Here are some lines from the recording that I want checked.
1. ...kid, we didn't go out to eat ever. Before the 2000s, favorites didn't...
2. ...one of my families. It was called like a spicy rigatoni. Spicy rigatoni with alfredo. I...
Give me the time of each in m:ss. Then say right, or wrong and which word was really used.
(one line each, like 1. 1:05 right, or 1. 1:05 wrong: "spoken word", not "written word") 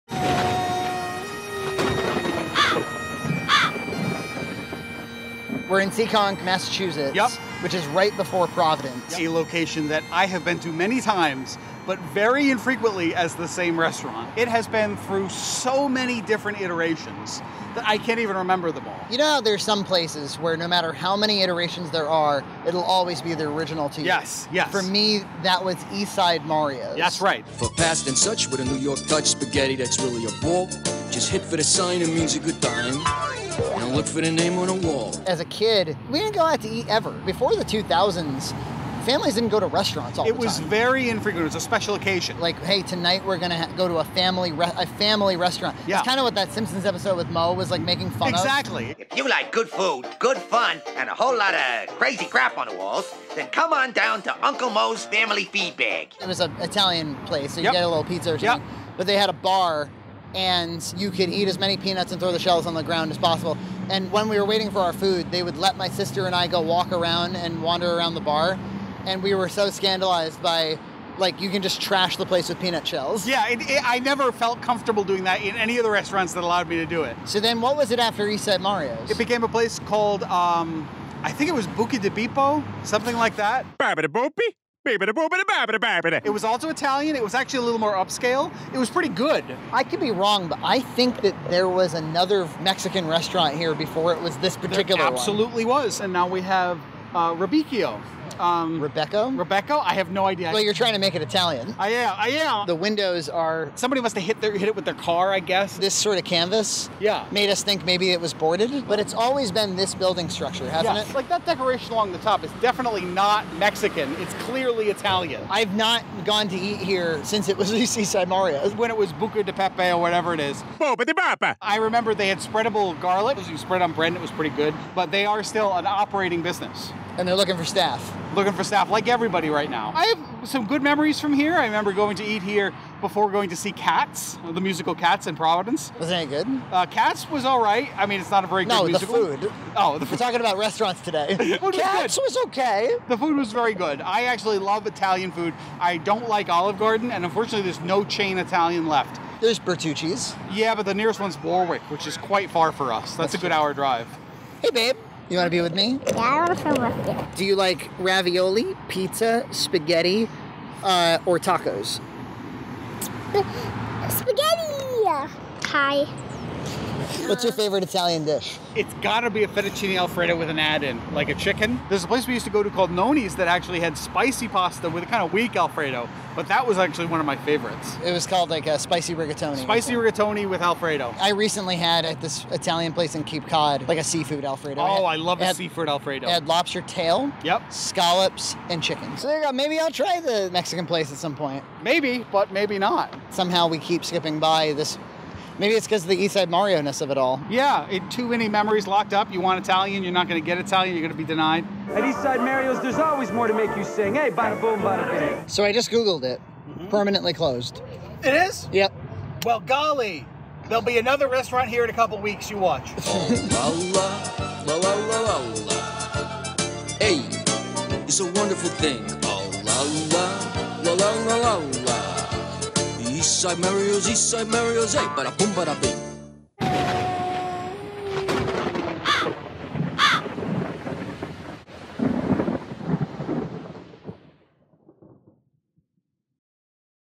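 1. 0:35 wrong: "families", not "favorites"
2. 2:57 wrong: "favorites", not "families".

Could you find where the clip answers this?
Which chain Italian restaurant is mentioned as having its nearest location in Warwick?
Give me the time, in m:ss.
2:29.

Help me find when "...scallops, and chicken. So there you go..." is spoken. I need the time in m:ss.
3:07.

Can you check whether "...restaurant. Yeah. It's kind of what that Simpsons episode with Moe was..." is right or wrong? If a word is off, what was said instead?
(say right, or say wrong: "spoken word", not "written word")
right.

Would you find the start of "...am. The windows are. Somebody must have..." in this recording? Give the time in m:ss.
1:42.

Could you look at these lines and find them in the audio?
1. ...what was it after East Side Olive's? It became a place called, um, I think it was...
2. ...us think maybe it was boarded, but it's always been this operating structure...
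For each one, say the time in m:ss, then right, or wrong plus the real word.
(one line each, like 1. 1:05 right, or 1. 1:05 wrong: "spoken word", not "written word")
1. 1:17 wrong: "Mario", not "Olive"
2. 1:47 wrong: "building", not "operating".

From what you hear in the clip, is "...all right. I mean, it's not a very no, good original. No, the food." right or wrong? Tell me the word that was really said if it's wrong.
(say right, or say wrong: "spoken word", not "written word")
wrong: "musical", not "original".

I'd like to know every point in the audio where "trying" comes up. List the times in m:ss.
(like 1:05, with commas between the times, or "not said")
1:40.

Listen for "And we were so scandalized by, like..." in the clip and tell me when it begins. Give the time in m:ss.
1:09.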